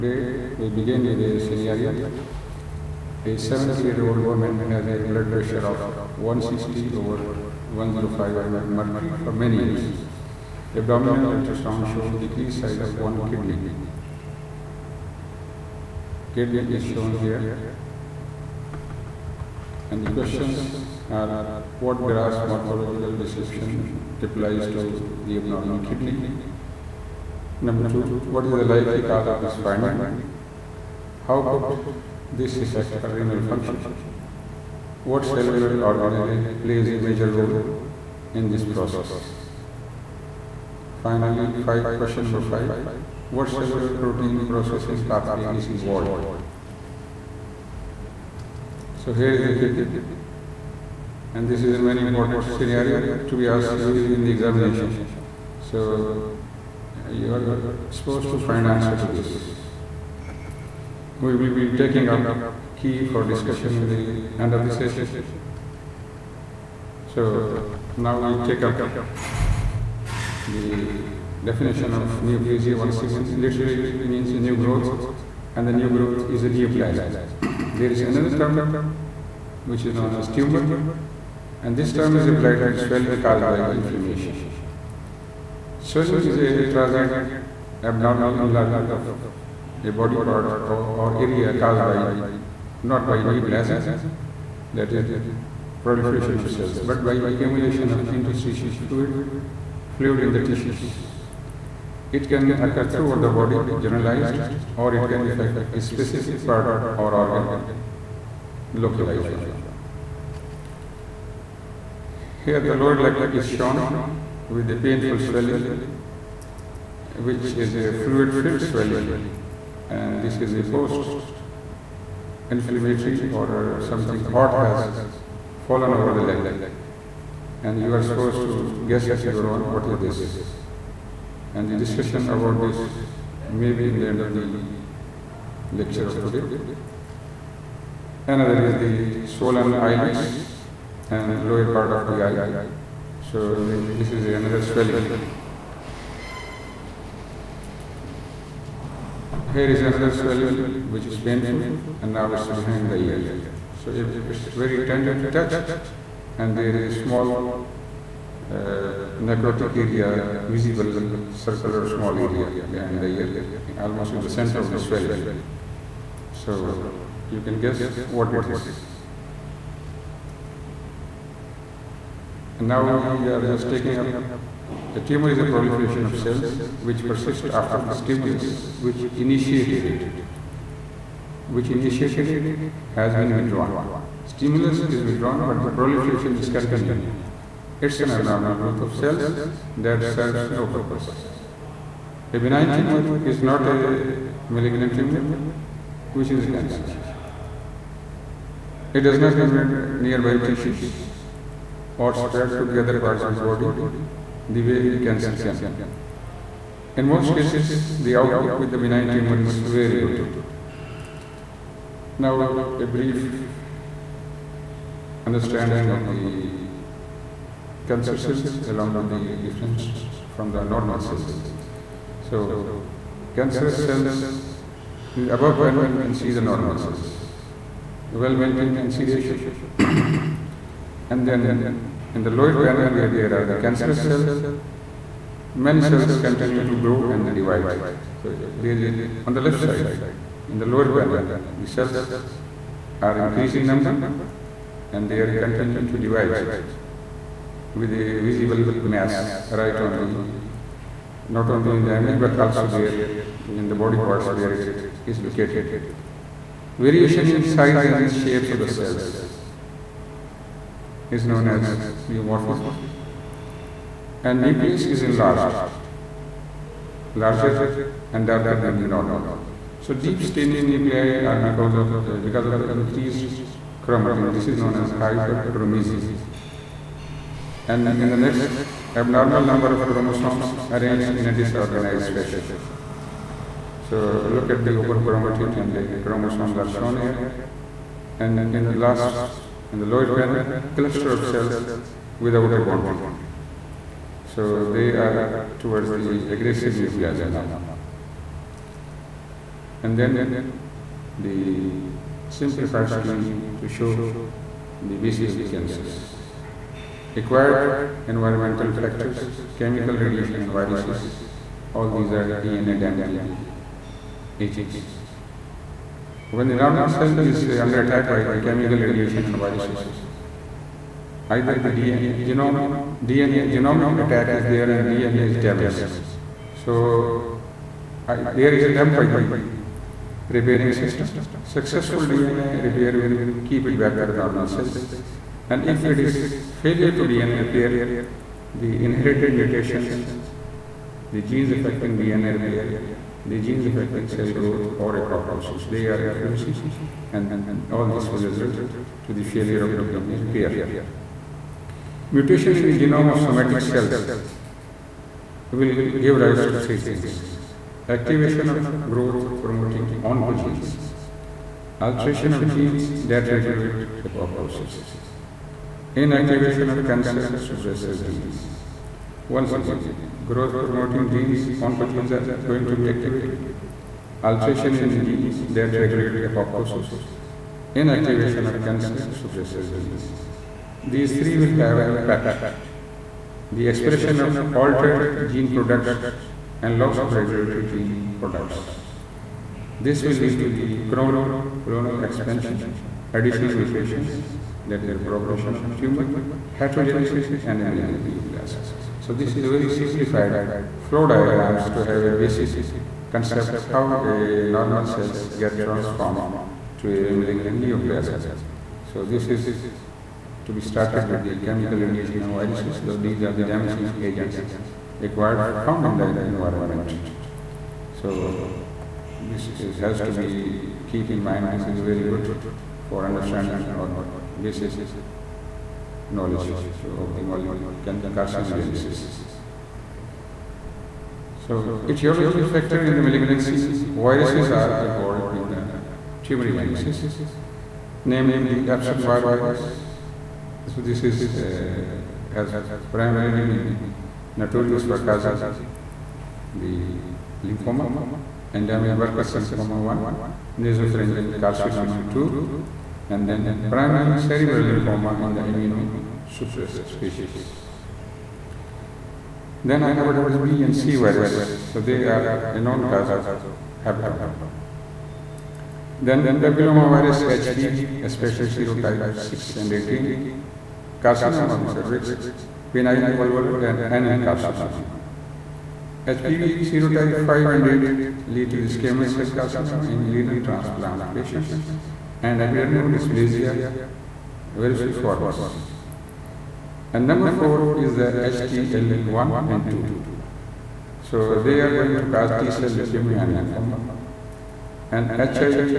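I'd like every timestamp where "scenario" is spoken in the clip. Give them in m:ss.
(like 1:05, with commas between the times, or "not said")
0:01, 0:52.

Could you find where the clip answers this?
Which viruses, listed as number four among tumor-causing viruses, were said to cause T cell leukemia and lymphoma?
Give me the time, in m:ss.
8:08.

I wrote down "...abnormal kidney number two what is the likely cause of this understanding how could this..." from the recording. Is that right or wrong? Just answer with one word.
wrong.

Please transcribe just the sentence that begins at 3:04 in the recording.
Stimulus is withdrawn but the proliferation is continuing.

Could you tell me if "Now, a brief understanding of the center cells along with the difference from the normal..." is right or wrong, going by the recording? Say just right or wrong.
wrong.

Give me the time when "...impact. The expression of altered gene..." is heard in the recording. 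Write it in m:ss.
6:21.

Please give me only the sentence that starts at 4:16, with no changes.
Variation in size and shapes of the cells is known as pleomorphism and nucleus is enlarged, larger and darker than the normal.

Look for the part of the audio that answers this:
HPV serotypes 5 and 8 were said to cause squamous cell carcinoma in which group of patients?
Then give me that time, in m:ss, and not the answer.
8:00.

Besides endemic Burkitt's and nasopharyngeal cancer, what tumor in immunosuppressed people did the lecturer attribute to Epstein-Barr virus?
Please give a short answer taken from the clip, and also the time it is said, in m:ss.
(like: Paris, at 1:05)
Primary cerebral lymphoma, at 7:33.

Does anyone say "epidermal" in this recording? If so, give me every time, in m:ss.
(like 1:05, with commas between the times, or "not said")
8:02.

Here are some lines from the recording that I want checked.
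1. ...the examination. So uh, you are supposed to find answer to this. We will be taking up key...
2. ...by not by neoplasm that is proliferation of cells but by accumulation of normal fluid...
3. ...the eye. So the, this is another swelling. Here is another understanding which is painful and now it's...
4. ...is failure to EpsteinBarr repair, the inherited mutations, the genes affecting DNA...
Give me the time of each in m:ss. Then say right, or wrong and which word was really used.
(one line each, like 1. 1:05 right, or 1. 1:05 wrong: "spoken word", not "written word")
1. 0:54 right
2. 1:31 wrong: "interstitial", not "normal"
3. 2:22 wrong: "swelling", not "understanding"
4. 5:35 wrong: "DNA", not "EpsteinBarr".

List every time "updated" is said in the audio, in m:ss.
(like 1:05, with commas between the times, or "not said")
not said.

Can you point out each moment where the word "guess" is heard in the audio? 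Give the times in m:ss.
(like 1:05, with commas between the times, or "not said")
2:08, 2:47.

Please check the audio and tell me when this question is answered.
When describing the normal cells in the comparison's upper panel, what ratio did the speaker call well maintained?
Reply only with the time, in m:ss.
3:48.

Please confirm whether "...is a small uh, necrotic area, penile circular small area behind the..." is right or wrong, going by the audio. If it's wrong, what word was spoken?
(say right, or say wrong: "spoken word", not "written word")
wrong: "visible", not "penile".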